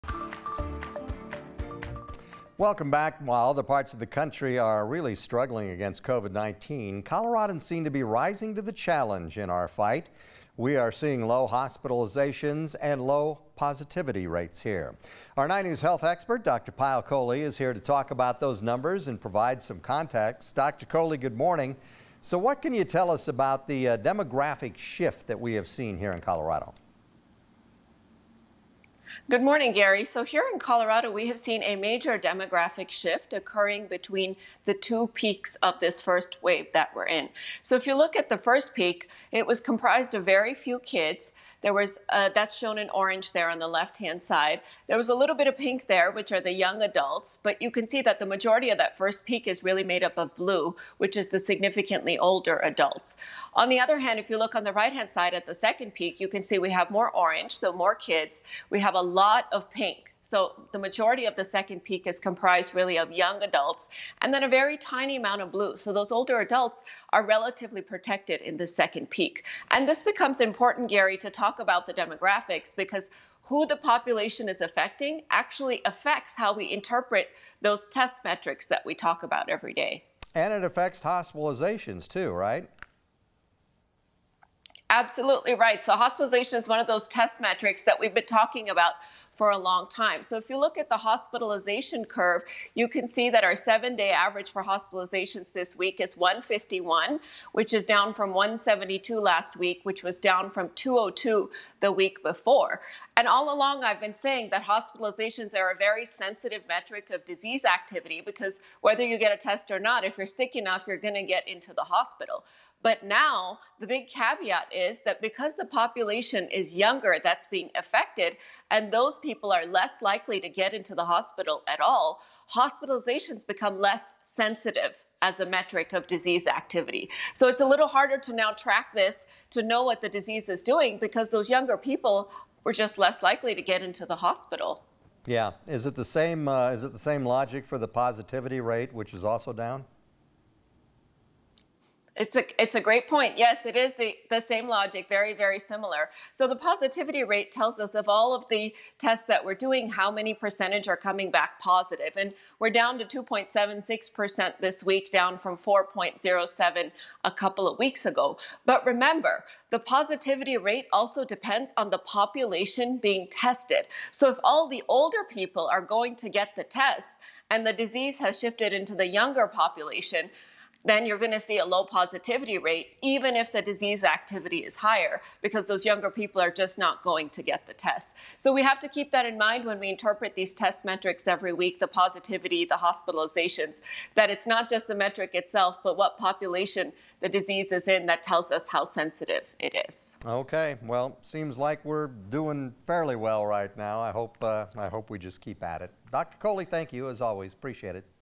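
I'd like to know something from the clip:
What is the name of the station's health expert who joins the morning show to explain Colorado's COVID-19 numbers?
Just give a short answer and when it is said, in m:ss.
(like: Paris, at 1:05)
Payal Kohli, at 0:16.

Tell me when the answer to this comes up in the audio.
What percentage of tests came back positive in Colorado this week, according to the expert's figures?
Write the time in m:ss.
2:33.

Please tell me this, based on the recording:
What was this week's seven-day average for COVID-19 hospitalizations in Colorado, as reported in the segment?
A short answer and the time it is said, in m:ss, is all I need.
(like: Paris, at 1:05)
151, at 1:36.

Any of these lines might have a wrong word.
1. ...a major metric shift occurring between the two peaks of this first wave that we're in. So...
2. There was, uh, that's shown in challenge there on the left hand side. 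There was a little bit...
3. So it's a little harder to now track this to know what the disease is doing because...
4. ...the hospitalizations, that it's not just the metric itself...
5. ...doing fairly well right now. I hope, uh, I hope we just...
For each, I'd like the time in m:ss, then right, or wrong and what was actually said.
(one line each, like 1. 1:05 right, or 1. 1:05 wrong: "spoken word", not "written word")
1. 0:31 wrong: "demographic", not "metric"
2. 0:41 wrong: "orange", not "challenge"
3. 2:07 right
4. 3:02 right
5. 3:12 right.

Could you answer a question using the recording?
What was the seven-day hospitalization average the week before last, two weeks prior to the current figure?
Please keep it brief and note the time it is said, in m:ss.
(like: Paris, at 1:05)
202, at 1:40.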